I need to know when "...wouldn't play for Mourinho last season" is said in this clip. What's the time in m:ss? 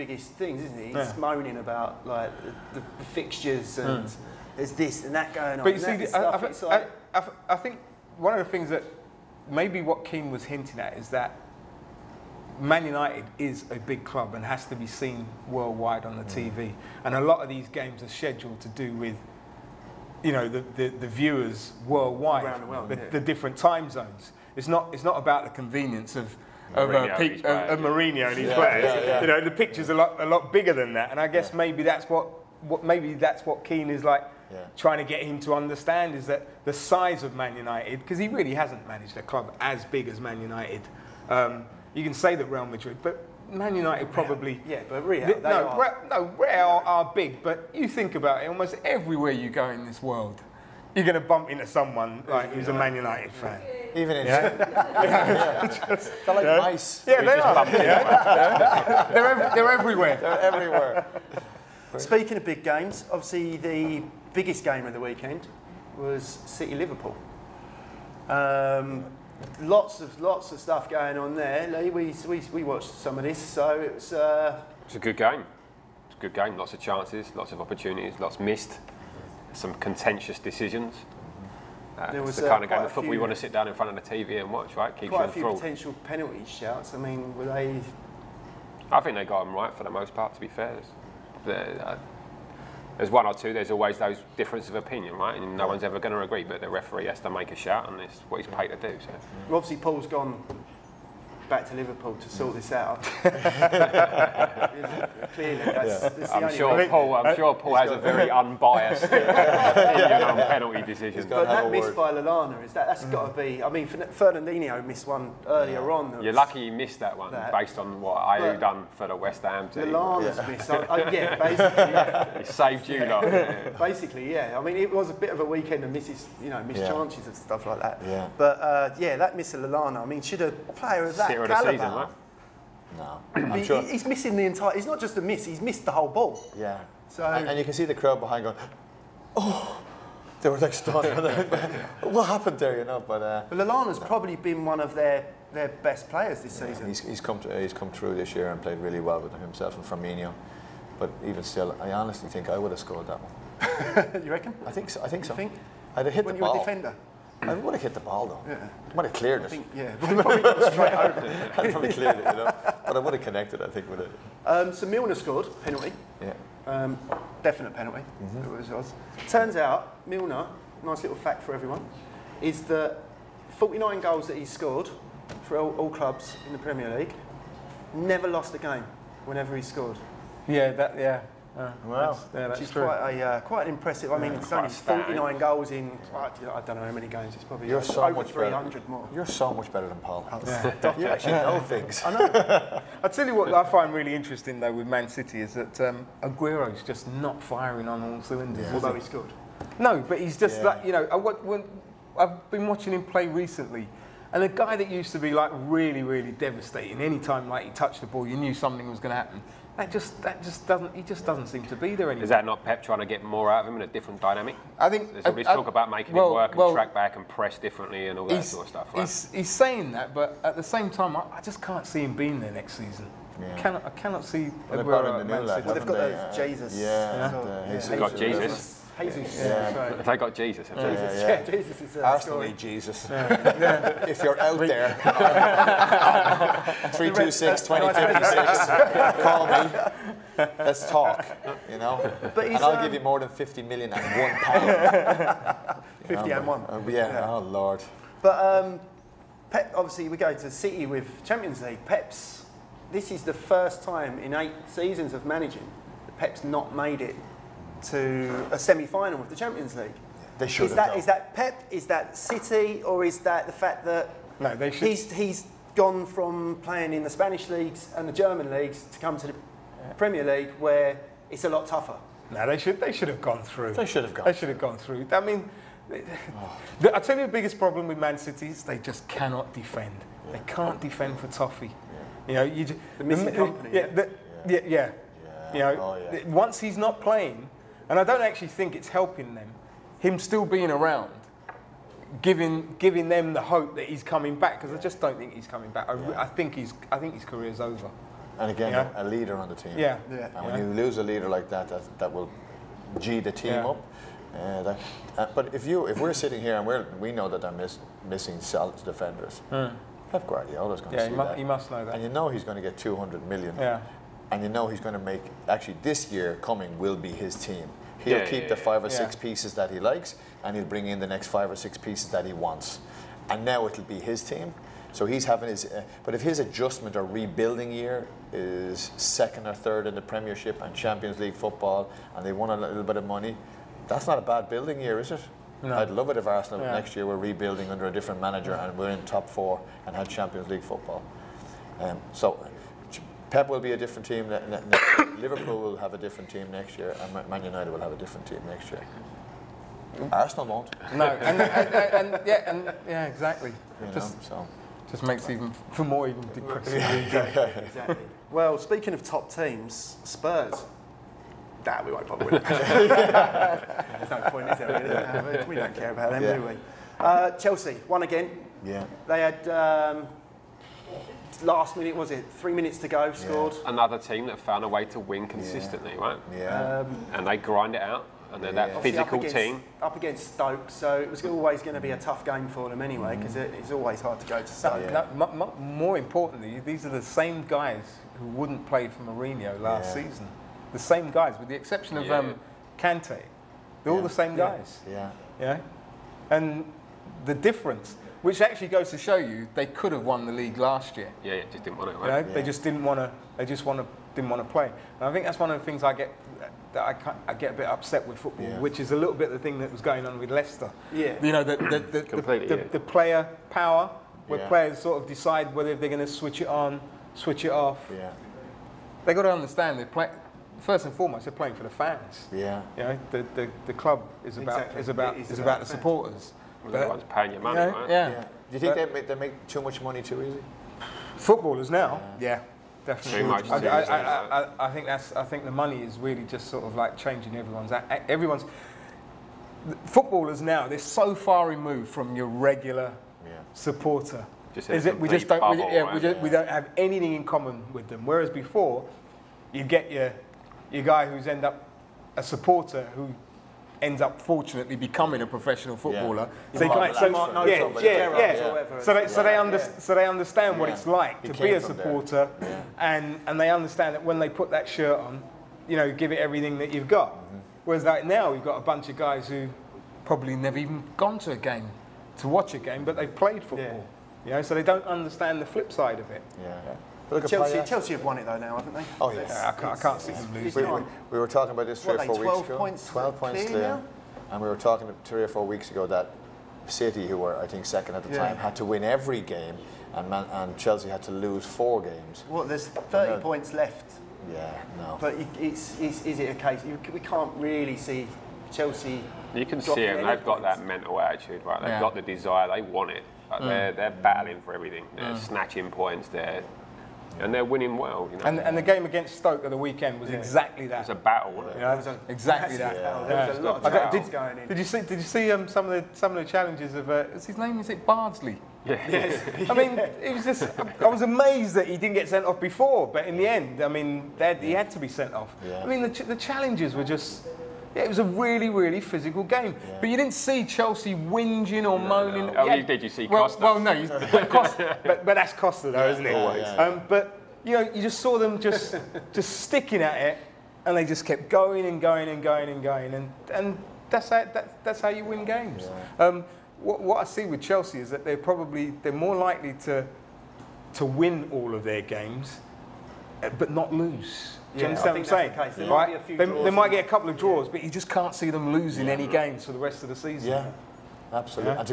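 6:28.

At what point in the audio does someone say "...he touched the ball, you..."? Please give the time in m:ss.
3:27.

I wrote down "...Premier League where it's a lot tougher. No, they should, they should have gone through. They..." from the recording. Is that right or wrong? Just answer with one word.
right.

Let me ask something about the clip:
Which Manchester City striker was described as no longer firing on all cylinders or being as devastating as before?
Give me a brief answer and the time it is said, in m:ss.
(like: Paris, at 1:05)
Aguero, at 3:16.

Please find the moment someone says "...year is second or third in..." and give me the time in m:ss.
5:27.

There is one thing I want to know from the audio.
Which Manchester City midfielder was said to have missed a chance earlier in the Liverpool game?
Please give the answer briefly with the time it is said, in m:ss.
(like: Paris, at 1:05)
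Fernandinho, at 1:53.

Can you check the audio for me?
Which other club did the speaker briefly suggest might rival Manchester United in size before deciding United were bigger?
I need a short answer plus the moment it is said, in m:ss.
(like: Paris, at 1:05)
Real Madrid, at 0:42.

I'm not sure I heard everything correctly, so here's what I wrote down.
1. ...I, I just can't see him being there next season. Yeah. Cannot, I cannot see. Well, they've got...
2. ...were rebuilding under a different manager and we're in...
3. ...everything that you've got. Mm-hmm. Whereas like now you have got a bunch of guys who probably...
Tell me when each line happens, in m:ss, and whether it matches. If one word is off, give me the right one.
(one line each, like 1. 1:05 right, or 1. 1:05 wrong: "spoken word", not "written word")
1. 3:41 right
2. 5:37 right
3. 7:46 right.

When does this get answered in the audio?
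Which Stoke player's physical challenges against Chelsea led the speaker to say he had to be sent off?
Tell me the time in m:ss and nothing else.
8:37.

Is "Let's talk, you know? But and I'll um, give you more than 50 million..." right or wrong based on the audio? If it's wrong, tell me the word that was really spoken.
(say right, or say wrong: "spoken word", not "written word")
right.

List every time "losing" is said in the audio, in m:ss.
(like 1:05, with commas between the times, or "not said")
8:00, 9:18.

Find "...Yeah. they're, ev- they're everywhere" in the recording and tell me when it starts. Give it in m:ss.
0:57.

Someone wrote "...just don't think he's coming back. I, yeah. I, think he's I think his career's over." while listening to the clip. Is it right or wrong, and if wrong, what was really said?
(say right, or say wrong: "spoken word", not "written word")
right.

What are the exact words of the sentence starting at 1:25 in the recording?
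quite a few potential penalty shouts.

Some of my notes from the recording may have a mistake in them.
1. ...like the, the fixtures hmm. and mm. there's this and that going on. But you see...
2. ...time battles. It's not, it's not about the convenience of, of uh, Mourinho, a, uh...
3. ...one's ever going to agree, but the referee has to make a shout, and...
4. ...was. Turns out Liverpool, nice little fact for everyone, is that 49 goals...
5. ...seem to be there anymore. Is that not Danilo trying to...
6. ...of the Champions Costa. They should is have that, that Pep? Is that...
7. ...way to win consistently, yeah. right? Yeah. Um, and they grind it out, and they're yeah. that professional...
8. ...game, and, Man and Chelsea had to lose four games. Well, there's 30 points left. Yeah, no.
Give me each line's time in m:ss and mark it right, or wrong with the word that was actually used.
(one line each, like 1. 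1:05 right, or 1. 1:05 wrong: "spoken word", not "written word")
1. 0:02 right
2. 0:23 wrong: "zones", not "battles"
3. 1:35 right
4. 2:48 wrong: "Milner", not "Liverpool"
5. 3:31 wrong: "Pep", not "Danilo"
6. 4:19 wrong: "League", not "Costa"
7. 6:14 wrong: "physical", not "professional"
8. 8:09 right.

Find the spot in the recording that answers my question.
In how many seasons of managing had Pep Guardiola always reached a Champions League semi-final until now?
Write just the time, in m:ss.
4:14.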